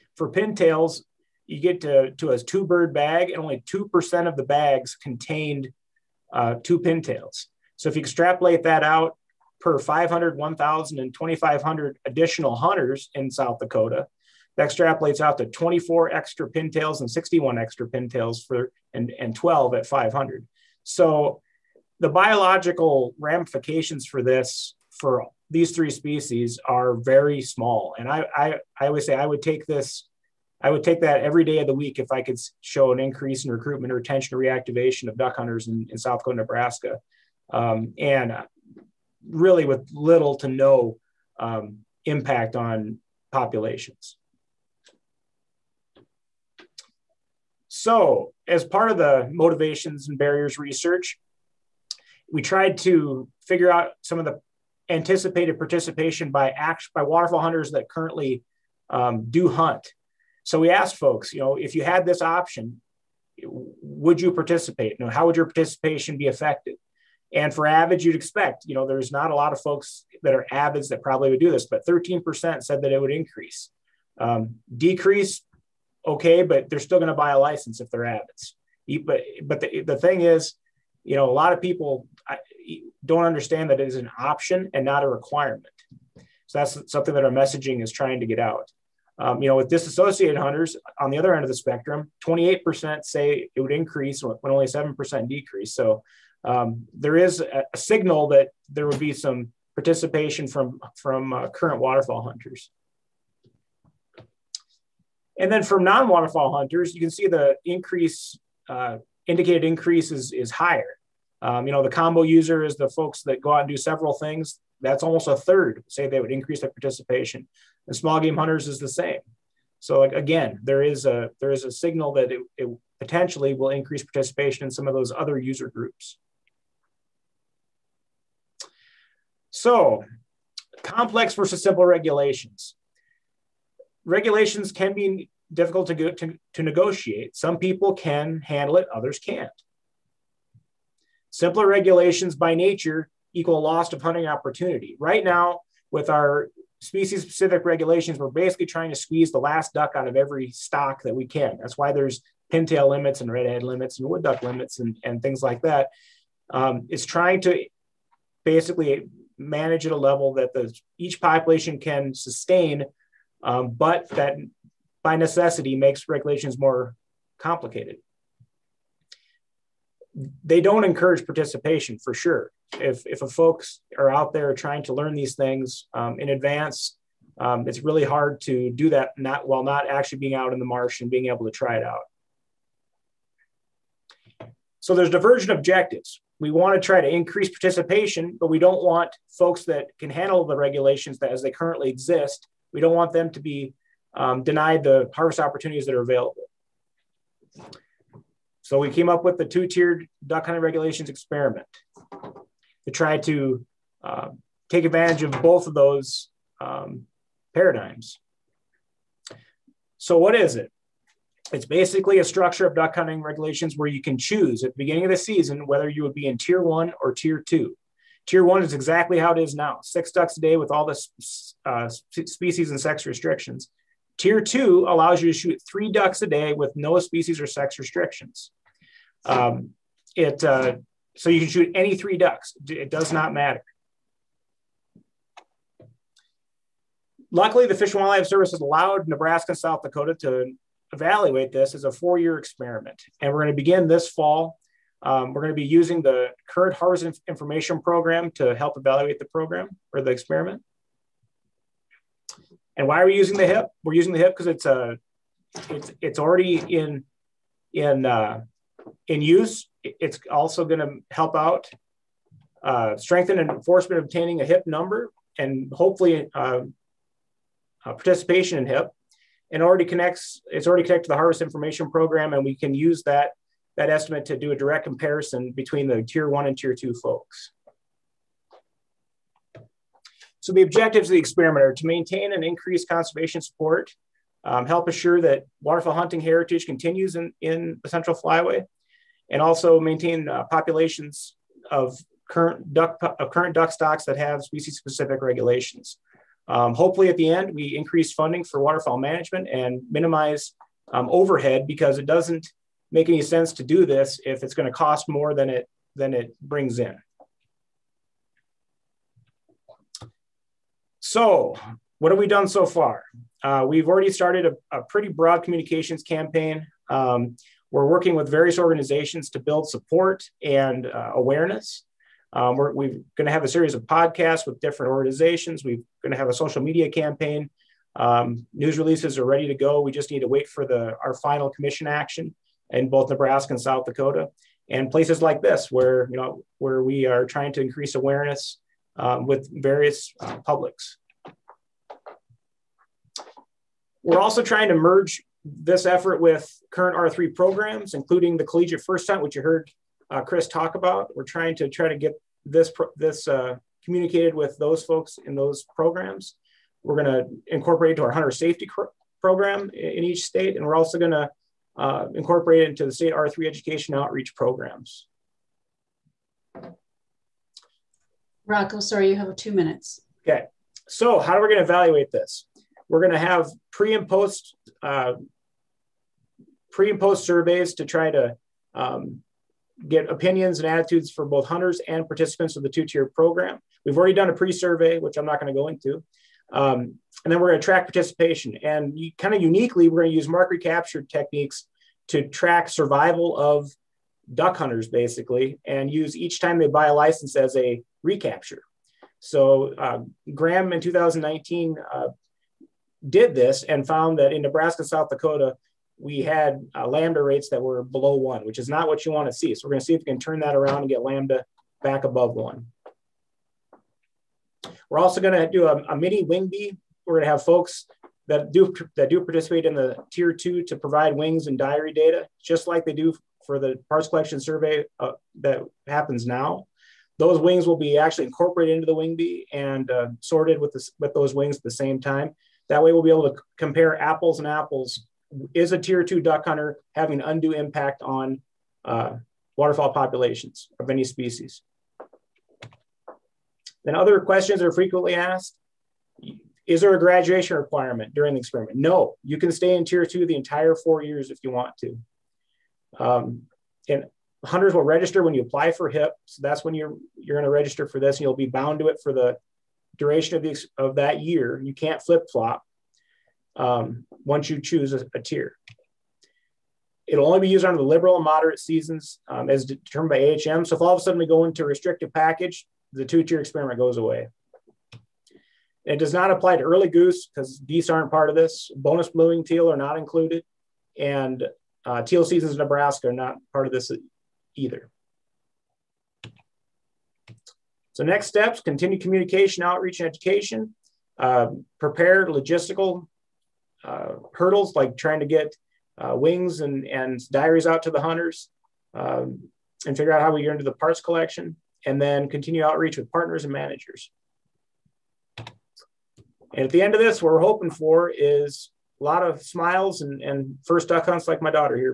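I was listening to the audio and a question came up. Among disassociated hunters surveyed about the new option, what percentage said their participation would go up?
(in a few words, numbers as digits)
28%.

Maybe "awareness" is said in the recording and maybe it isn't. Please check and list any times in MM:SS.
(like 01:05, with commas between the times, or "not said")
05:21, 05:37.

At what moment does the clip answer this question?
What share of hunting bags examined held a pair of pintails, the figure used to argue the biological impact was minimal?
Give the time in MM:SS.
00:03.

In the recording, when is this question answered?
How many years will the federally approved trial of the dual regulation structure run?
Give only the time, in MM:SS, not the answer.
04:01.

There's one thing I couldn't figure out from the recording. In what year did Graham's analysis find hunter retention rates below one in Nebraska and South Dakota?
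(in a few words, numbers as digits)
2019.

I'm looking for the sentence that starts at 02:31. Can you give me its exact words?
That's why there's pintail limits and redhead limits and wood duck limits and, and things like that.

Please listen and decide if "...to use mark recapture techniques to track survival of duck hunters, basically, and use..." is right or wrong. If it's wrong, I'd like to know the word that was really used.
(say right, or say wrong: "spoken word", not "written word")
right.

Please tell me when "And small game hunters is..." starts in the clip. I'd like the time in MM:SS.
01:57.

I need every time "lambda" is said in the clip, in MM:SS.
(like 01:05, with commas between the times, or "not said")
06:46, 06:51.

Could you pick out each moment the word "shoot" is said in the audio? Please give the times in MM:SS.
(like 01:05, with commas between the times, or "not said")
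03:45, 03:51.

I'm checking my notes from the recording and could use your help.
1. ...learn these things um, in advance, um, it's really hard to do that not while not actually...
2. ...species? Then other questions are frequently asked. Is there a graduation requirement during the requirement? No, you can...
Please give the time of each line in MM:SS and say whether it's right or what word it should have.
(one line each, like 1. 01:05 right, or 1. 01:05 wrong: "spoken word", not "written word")
1. 02:54 right
2. 07:21 wrong: "experiment", not "requirement".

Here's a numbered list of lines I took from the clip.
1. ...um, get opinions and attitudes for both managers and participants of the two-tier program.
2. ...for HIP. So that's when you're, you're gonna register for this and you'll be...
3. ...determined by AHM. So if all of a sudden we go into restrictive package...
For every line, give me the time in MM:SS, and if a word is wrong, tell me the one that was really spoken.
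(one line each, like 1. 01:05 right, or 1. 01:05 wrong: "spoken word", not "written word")
1. 06:18 wrong: "hunters", not "managers"
2. 07:35 right
3. 07:49 right.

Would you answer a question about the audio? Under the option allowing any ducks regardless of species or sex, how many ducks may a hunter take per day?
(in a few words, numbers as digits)
3.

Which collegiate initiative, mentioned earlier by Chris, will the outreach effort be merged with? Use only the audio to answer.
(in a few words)
collegiate first time.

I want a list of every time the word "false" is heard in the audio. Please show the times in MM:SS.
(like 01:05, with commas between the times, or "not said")
not said.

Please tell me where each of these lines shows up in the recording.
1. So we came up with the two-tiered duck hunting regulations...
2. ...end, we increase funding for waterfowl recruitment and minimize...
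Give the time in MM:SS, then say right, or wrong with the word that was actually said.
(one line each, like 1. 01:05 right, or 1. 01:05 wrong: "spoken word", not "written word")
1. 03:18 right
2. 04:57 wrong: "management", not "recruitment".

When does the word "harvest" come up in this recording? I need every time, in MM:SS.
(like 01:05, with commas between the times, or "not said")
03:15, 04:06, 04:31.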